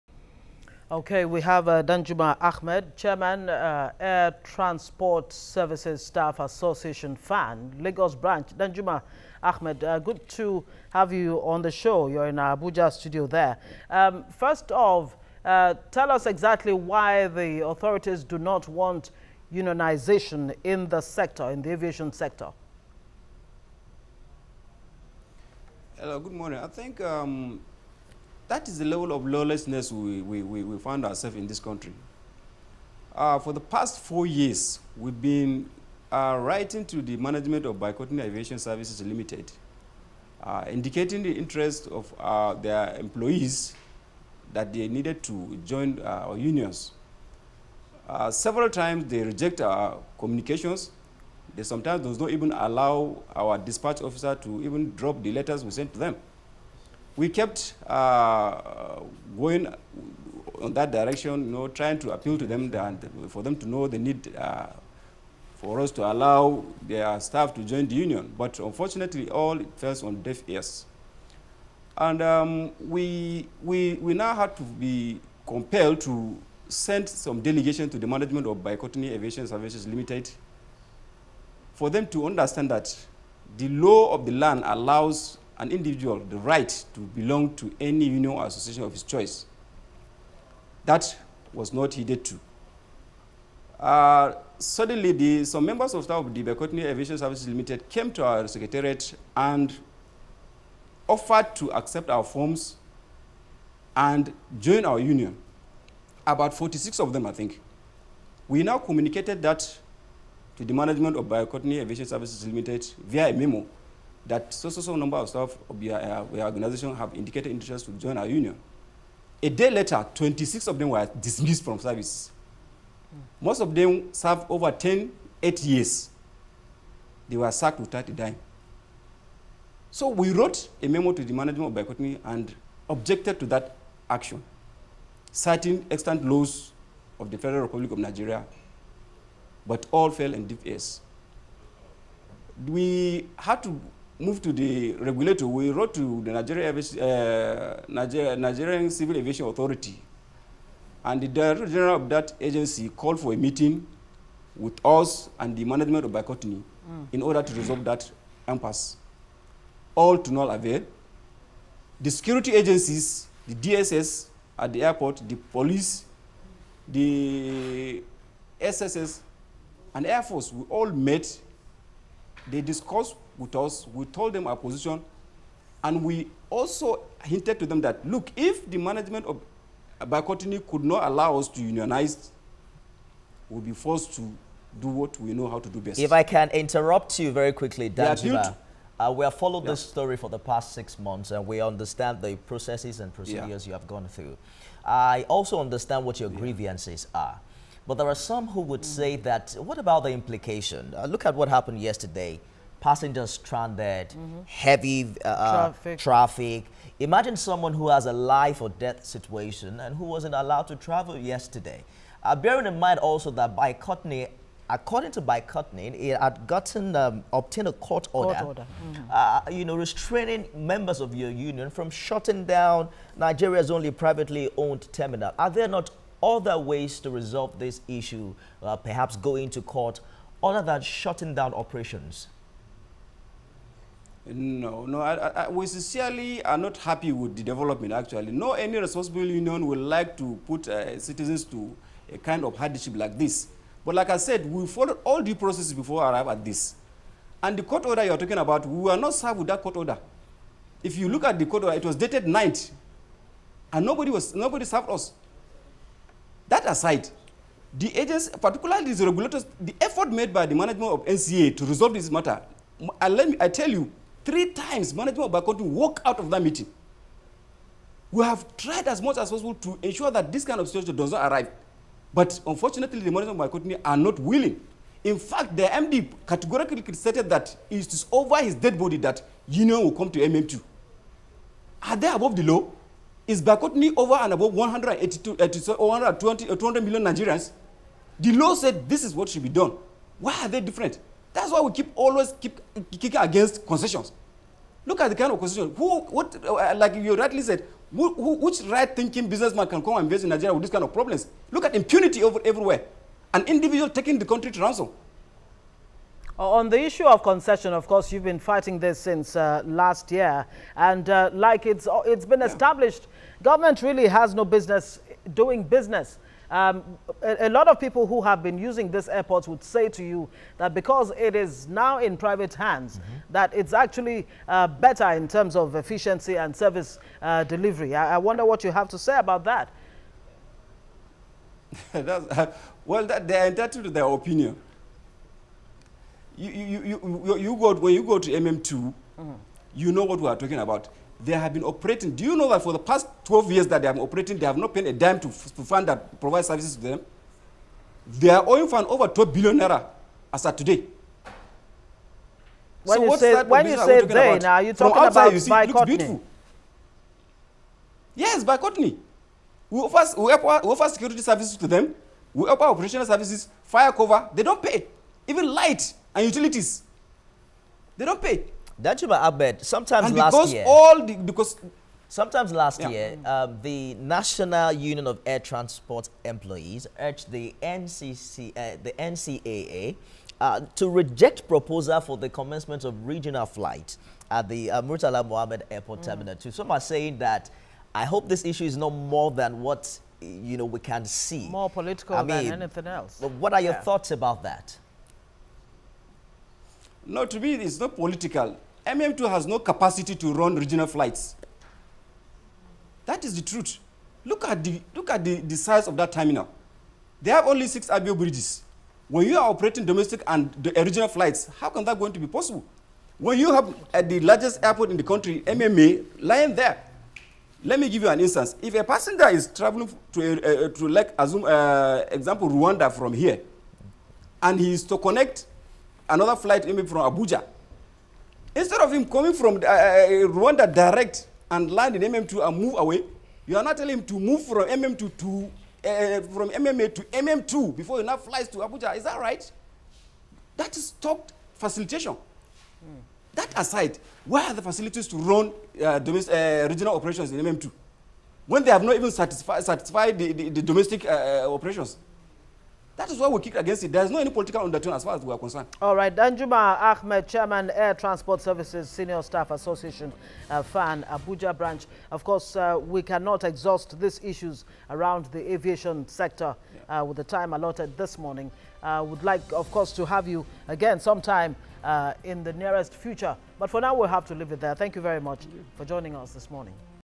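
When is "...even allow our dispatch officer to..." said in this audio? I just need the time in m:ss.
0:52.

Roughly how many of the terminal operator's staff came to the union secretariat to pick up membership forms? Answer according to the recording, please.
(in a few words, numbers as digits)
46.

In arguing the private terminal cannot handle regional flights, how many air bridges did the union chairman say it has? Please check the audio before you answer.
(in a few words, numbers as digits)
6.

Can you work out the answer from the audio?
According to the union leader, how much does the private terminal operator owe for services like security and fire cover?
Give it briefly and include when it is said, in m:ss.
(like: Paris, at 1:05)
over 12 billion naira, at 5:48.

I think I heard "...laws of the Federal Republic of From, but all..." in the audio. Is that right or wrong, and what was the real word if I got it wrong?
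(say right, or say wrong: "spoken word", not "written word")
wrong: "Nigeria", not "From".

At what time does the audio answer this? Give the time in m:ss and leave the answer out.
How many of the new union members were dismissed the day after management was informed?
2:00.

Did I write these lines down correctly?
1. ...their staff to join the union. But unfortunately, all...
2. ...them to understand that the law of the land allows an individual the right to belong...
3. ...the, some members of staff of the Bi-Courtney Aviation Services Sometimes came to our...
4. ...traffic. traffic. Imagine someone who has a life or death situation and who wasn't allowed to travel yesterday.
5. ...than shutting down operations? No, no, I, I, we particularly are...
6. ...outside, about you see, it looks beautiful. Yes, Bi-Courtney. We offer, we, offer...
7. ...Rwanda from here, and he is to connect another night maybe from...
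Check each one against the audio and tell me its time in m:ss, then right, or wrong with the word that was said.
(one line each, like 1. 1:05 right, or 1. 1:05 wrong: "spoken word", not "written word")
1. 1:06 right
2. 1:21 right
3. 1:35 wrong: "Limited", not "Sometimes"
4. 3:25 right
5. 3:50 wrong: "sincerely", not "particularly"
6. 5:55 right
7. 7:02 wrong: "flight", not "night".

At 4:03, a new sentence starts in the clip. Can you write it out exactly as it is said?
But like I said, we followed all due processes before I arrive at this.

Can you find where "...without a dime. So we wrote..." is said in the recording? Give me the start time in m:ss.
2:07.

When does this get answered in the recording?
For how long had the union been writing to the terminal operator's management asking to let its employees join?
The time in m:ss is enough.
0:34.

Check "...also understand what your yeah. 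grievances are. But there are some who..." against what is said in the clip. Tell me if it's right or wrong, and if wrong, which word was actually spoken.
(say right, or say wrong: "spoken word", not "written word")
right.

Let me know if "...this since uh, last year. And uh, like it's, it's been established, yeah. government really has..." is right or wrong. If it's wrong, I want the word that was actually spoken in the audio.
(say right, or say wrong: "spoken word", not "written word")
right.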